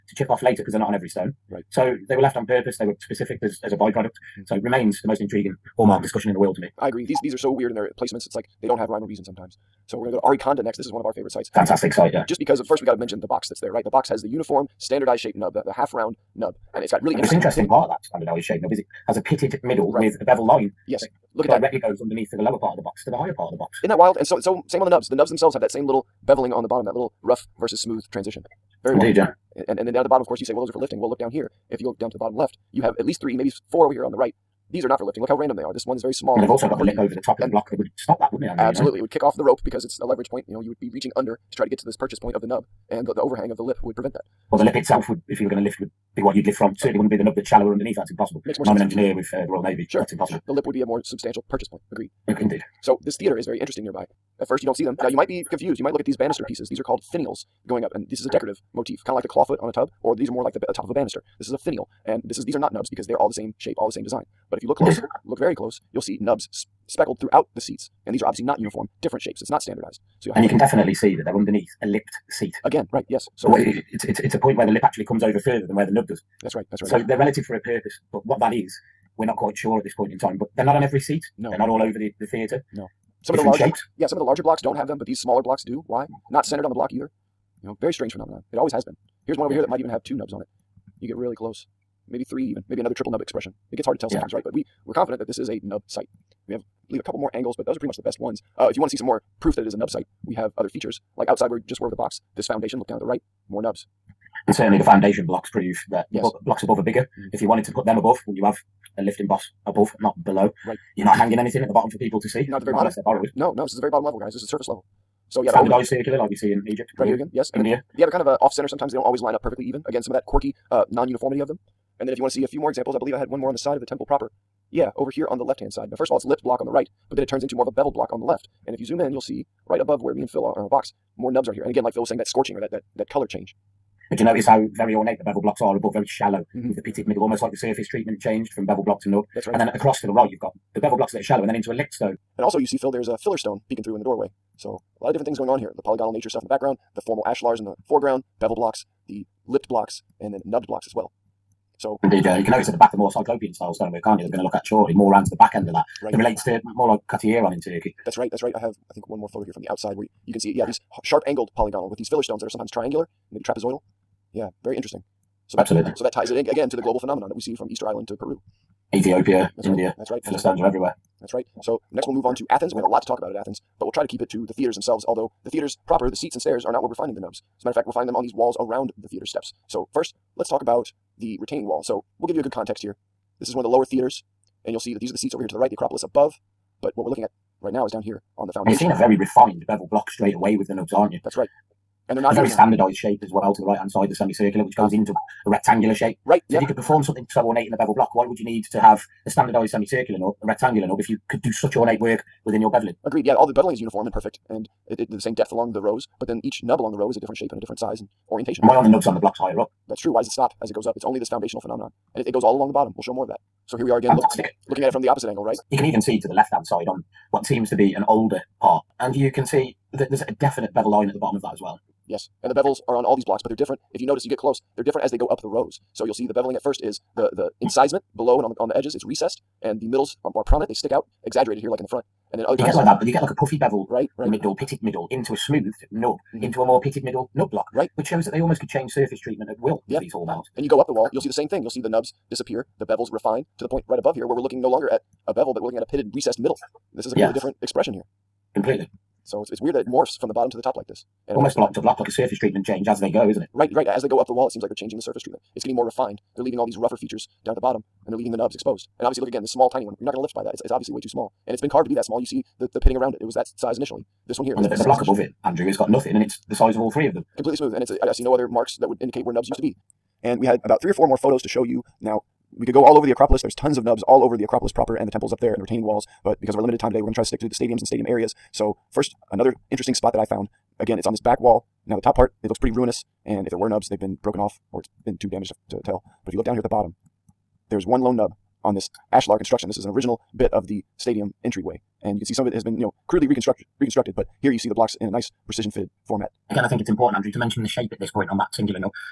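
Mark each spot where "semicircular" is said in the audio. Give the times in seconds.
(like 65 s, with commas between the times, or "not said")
194 s, 199 s.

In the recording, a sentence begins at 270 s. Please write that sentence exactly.
And we had about three or four more photos to show you.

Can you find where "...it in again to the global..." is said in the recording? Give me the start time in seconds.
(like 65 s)
166 s.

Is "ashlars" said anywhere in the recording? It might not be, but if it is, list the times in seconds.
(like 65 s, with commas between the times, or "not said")
147 s, 289 s.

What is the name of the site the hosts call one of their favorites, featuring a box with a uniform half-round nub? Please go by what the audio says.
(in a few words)
Arykanda.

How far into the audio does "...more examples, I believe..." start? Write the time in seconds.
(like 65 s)
122 s.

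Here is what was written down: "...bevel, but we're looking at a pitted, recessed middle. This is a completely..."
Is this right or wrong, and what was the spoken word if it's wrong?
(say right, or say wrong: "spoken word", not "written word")
right.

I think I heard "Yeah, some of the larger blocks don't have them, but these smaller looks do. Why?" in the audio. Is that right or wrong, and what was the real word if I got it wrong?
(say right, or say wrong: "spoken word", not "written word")
wrong: "blocks", not "looks".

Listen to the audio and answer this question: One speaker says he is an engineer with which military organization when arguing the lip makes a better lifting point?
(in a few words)
Royal Navy.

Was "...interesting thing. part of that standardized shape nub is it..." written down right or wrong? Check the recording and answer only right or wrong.
right.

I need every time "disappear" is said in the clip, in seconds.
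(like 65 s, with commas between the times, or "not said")
242 s.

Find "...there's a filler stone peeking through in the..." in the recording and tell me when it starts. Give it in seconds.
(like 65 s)
142 s.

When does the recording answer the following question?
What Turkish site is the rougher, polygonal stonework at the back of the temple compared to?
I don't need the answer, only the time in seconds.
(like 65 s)
157 s.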